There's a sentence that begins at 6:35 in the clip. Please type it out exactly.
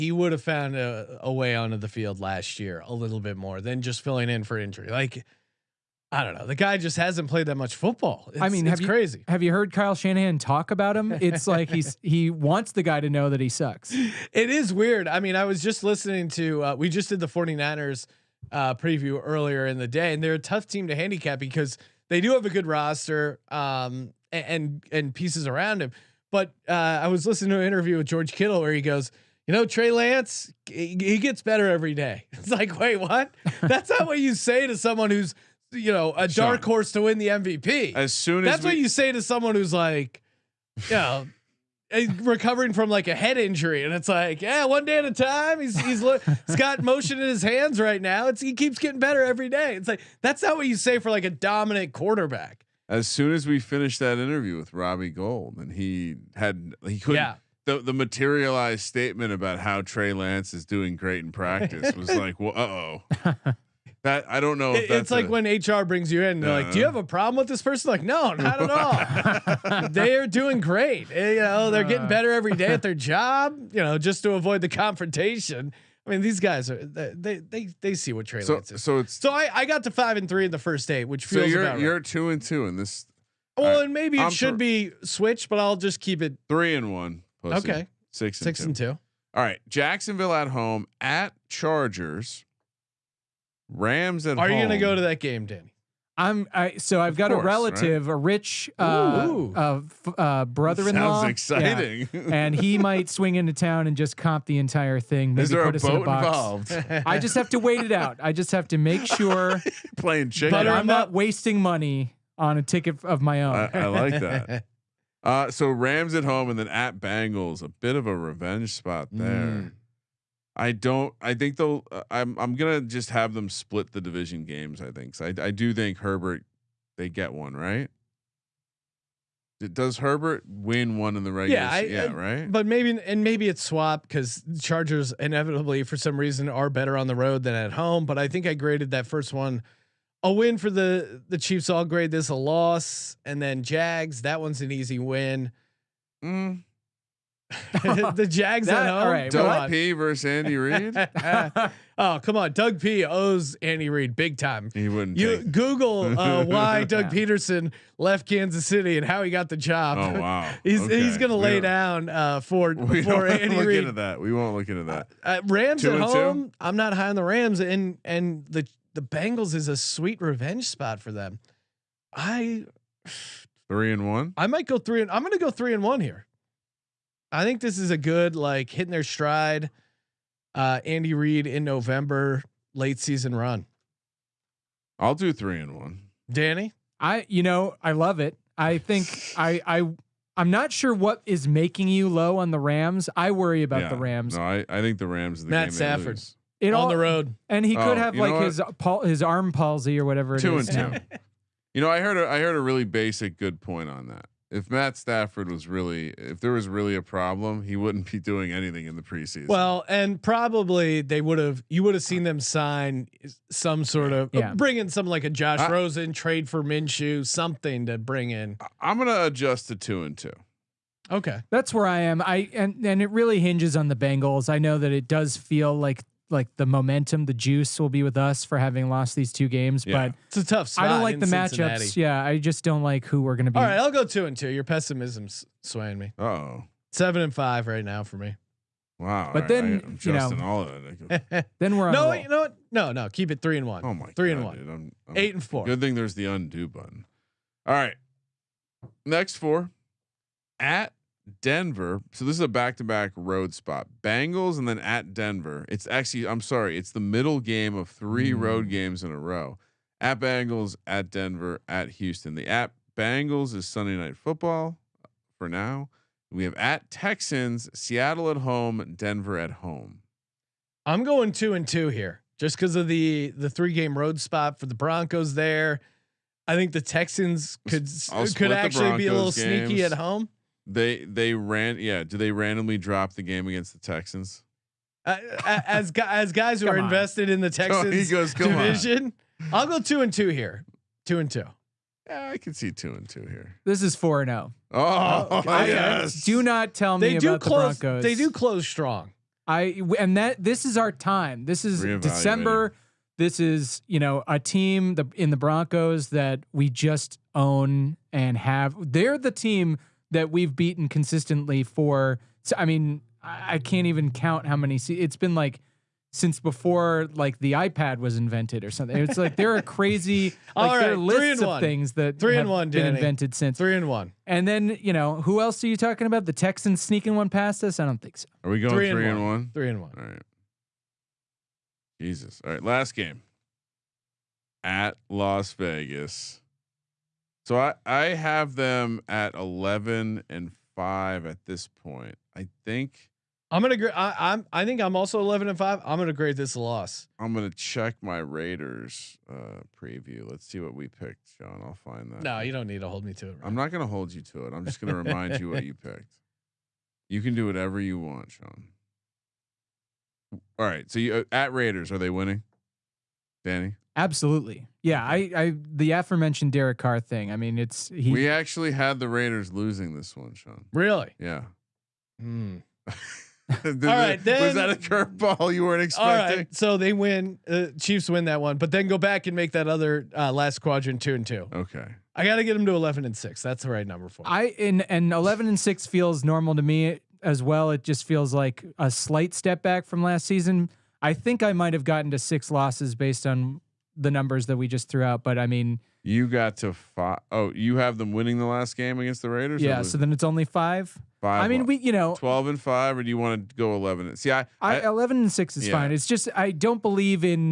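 But I mean, you got to five.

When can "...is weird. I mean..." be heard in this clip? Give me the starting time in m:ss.
0:14.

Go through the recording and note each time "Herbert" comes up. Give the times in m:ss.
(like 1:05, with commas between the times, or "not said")
2:05, 2:09.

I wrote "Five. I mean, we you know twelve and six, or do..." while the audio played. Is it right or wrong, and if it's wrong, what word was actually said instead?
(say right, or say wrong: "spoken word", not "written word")
wrong: "five", not "six".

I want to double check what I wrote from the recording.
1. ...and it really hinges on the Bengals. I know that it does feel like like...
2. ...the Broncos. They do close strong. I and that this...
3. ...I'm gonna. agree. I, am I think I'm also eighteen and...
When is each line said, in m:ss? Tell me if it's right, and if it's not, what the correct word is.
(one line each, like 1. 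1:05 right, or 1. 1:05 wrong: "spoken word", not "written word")
1. 3:42 right
2. 4:57 right
3. 5:43 wrong: "eleven", not "eighteen".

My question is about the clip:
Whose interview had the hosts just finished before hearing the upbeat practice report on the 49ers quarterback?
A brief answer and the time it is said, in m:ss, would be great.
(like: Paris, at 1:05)
Robbie Gold, at 0:54.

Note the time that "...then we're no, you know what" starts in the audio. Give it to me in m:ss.
4:01.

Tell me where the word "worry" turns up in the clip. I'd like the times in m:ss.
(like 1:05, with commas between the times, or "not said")
3:13.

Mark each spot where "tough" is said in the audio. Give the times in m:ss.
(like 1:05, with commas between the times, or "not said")
0:20, 3:50.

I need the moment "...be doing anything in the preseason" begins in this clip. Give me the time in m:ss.
3:28.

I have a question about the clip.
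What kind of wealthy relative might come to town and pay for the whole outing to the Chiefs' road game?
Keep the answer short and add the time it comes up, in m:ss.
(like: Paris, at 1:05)
brother-in-law, at 1:40.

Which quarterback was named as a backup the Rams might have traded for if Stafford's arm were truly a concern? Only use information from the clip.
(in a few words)
Minshew.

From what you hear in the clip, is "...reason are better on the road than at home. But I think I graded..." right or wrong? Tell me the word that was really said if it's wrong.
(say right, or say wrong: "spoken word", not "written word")
right.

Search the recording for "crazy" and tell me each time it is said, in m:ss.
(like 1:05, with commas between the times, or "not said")
0:08, 5:19.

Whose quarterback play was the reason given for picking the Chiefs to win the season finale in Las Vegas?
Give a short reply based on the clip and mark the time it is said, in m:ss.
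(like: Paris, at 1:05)
Derek Carr, at 6:06.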